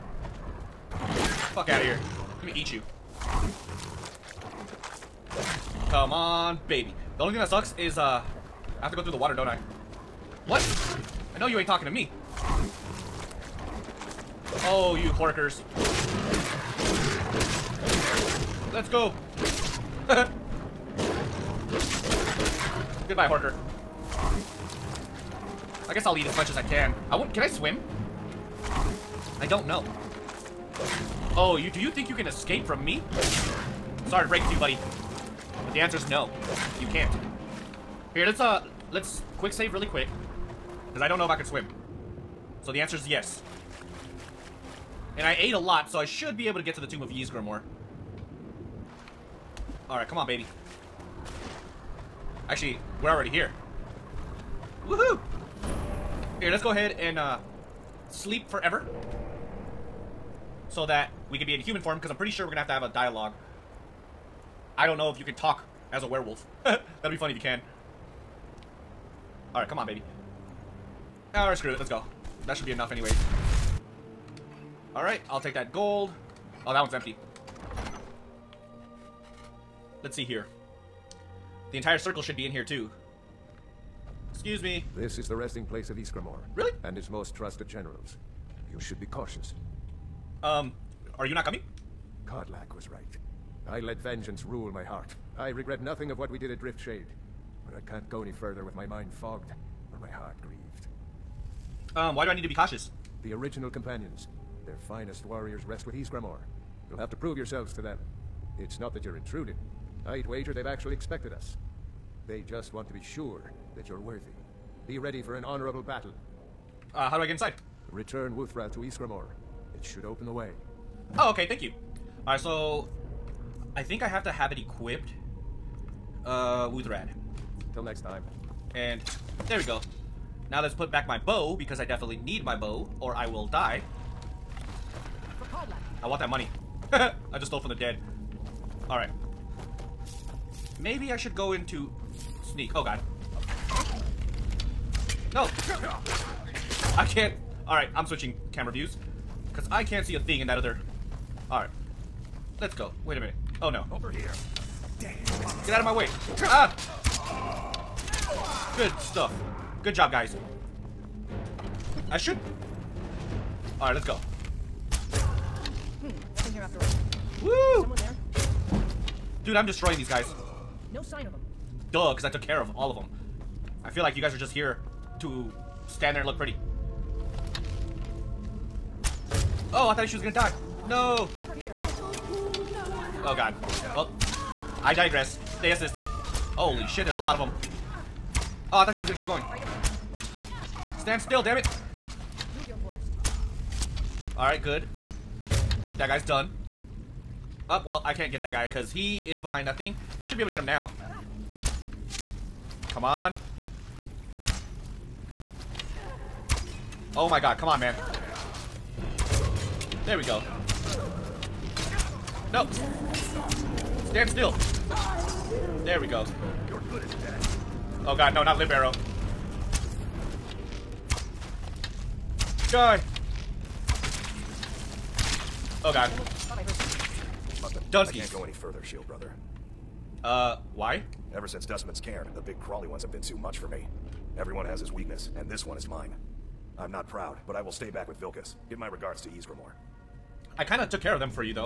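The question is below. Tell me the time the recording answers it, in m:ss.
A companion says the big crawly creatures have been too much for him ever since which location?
3:51.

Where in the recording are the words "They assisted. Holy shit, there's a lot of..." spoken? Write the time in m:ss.
3:05.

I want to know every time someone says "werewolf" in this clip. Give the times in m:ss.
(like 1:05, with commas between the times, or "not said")
1:06.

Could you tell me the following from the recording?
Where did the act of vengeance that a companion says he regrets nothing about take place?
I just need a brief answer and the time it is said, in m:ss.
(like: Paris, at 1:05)
Driftshade, at 1:36.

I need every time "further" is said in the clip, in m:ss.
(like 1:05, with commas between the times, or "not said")
1:38, 3:48.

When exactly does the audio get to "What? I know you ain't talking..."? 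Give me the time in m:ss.
0:10.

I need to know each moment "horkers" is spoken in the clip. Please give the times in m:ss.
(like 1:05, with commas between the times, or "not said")
0:15, 0:23.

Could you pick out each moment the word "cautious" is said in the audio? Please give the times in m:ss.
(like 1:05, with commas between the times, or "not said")
1:29, 1:42.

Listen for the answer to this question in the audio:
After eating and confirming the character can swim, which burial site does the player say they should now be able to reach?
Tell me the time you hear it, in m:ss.
0:46.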